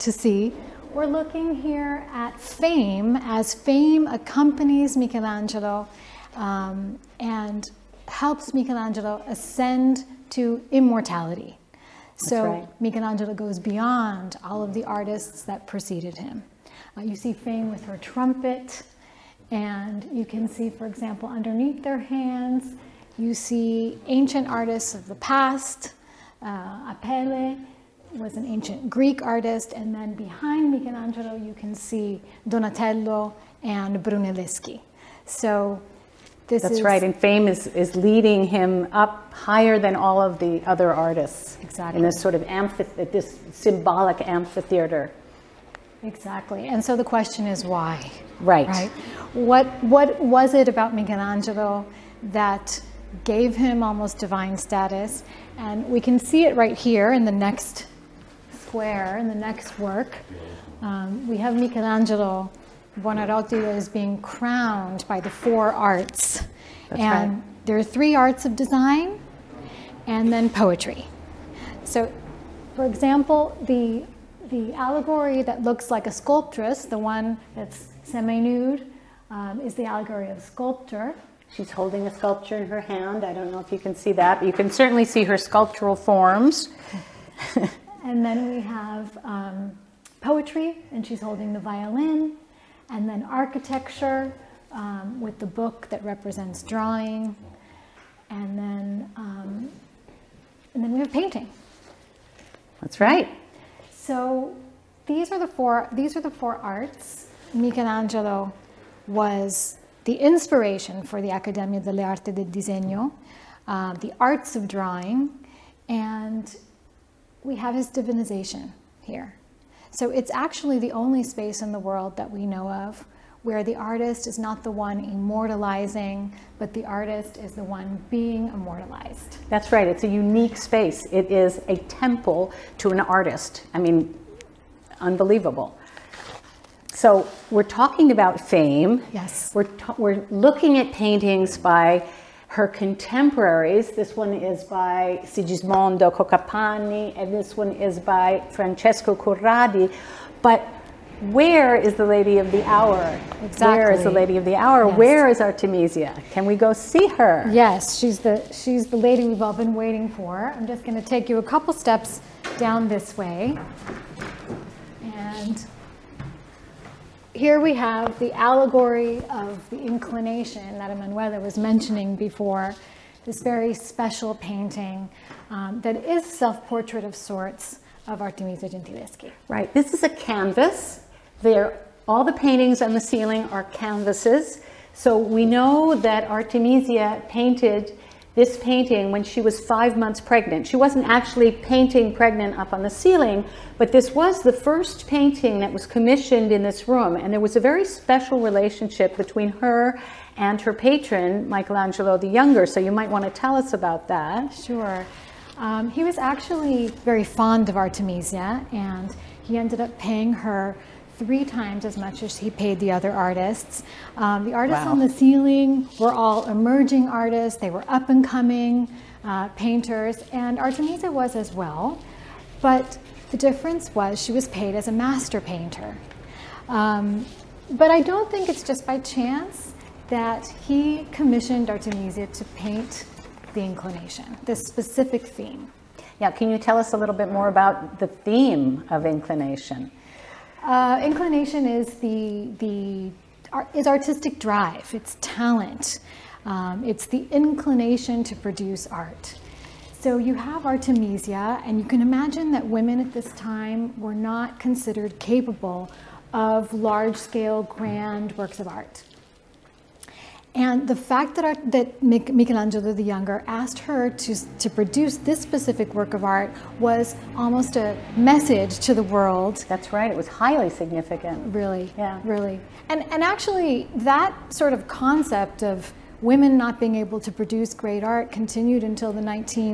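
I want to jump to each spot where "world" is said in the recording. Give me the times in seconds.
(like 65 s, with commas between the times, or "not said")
121 s, 269 s.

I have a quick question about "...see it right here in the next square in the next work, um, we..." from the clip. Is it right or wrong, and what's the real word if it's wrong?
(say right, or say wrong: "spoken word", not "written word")
right.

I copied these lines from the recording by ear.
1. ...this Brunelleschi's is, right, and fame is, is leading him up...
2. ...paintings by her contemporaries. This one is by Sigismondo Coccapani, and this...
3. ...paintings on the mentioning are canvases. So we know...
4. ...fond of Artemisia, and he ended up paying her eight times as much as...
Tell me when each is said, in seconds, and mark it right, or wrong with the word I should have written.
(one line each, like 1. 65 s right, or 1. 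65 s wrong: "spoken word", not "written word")
1. 36 s wrong: "That", not "Brunelleschi"
2. 140 s right
3. 182 s wrong: "ceiling", not "mentioning"
4. 207 s wrong: "three", not "eight".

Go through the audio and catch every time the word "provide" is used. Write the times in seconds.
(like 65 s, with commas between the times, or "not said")
not said.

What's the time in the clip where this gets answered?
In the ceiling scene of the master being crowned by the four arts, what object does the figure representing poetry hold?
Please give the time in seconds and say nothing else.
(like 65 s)
91 s.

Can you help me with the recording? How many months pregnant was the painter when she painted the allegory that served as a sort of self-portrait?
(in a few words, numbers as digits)
5.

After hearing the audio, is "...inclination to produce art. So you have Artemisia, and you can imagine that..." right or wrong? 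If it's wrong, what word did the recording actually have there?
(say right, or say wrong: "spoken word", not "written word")
right.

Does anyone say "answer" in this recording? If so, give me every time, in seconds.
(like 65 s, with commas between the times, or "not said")
not said.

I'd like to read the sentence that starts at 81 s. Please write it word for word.
She's holding a sculpture in her hand.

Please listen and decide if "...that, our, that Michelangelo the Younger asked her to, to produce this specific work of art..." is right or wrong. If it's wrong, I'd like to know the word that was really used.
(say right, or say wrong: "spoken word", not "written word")
right.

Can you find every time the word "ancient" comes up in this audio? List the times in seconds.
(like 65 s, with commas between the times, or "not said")
24 s, 28 s.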